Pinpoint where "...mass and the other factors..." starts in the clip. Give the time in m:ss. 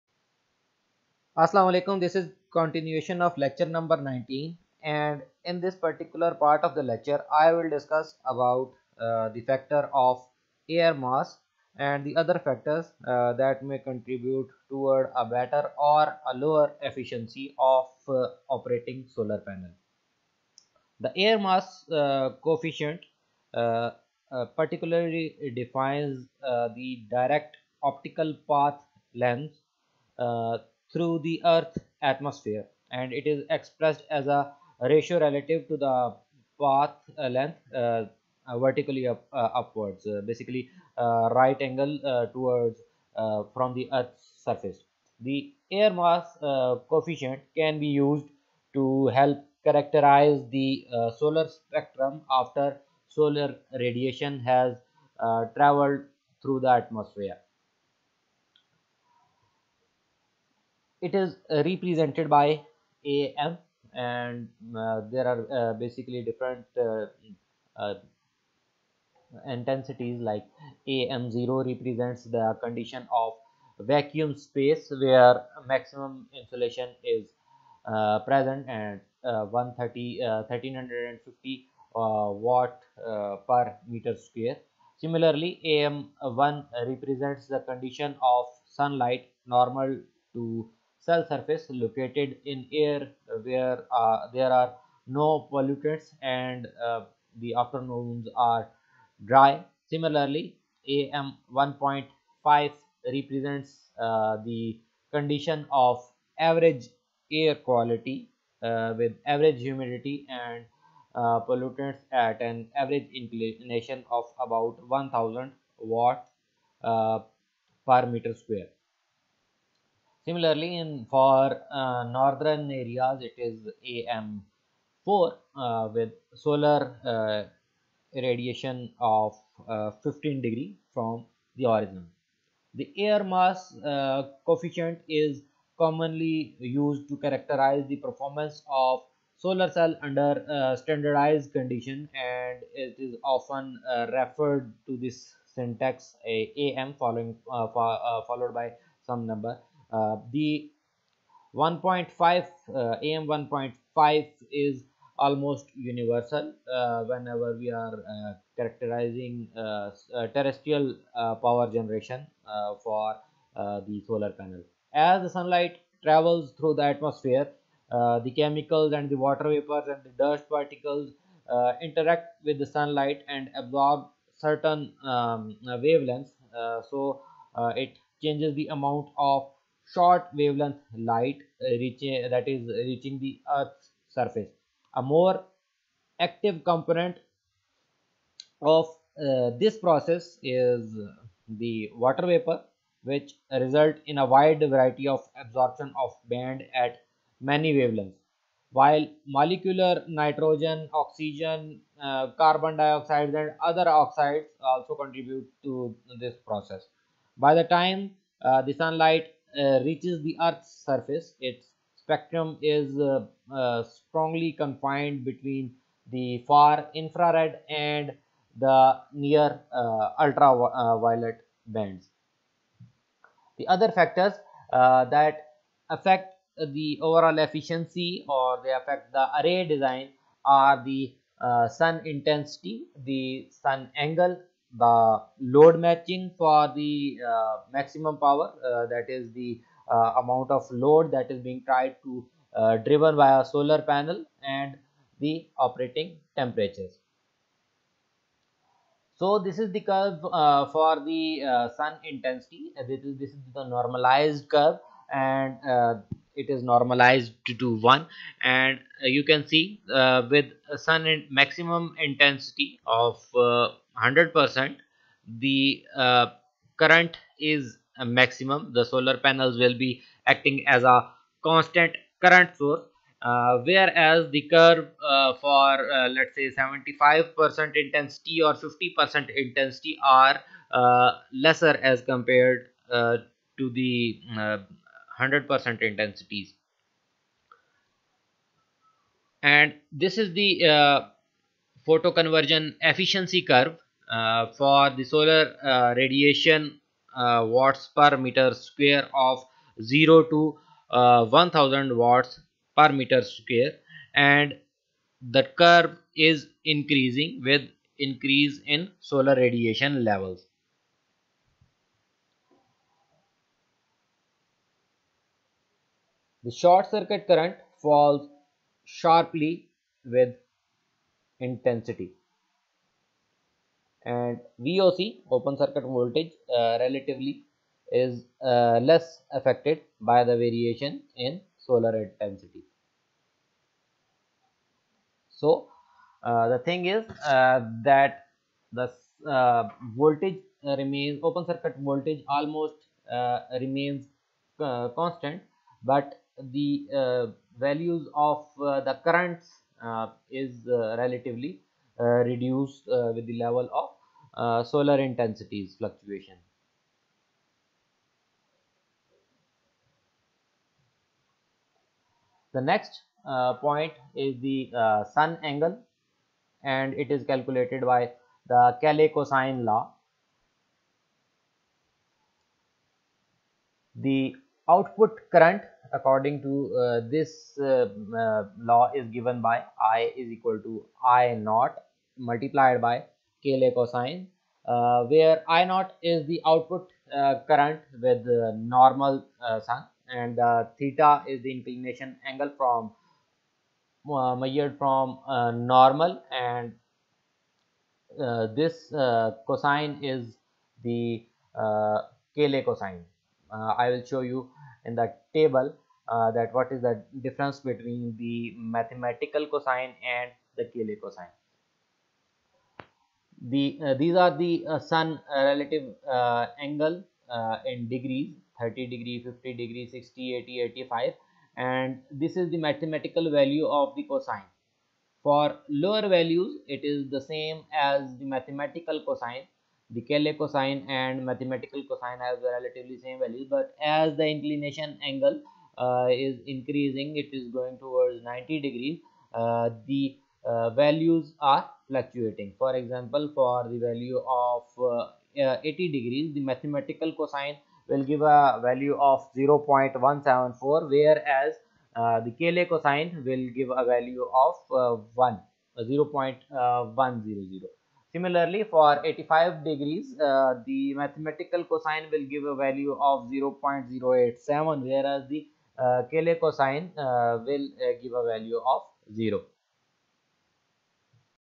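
0:10.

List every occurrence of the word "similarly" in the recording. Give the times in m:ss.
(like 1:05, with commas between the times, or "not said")
1:25, 1:39, 2:00, 7:38.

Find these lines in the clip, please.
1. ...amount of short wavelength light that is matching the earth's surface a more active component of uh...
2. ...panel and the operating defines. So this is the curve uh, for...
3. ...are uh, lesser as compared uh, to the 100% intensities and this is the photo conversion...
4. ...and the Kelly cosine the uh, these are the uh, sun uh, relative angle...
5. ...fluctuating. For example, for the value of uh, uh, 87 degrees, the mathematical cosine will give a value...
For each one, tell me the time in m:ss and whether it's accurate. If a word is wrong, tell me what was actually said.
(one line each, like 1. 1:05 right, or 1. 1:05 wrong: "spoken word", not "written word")
1. 2:58 wrong: "reaching", not "matching"
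2. 4:03 wrong: "temperatures", not "defines"
3. 4:40 right
4. 6:50 right
5. 7:21 wrong: "80", not "87".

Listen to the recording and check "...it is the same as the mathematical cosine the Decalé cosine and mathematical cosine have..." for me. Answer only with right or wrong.
right.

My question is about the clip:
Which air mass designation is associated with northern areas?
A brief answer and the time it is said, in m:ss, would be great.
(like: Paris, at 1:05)
AM4, at 2:03.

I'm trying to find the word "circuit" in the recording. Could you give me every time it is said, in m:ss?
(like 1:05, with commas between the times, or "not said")
5:16, 5:25, 5:41.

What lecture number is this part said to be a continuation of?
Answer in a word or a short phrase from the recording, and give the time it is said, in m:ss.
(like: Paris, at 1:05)
19, at 0:03.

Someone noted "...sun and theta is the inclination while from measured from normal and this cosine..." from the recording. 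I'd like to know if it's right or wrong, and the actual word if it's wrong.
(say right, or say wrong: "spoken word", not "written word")
wrong: "angle", not "while".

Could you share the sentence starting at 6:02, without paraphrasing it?
The next uh, point is the uh, sun angle and it is calculated by the Kelly cosine law.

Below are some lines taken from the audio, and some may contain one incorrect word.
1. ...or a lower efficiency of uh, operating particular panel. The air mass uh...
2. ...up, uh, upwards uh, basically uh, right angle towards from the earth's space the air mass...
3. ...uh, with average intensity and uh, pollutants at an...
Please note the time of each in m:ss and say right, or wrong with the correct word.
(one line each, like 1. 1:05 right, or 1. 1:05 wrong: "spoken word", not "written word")
1. 0:15 wrong: "solar", not "particular"
2. 0:39 wrong: "surface", not "space"
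3. 1:48 wrong: "humidity", not "intensity".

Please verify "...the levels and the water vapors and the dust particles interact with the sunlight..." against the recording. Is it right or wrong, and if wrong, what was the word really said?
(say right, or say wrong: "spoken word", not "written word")
wrong: "chemicals", not "levels".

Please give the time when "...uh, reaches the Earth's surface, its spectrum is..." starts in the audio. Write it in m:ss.
3:29.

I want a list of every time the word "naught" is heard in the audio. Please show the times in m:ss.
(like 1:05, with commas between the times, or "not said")
6:21, 6:25.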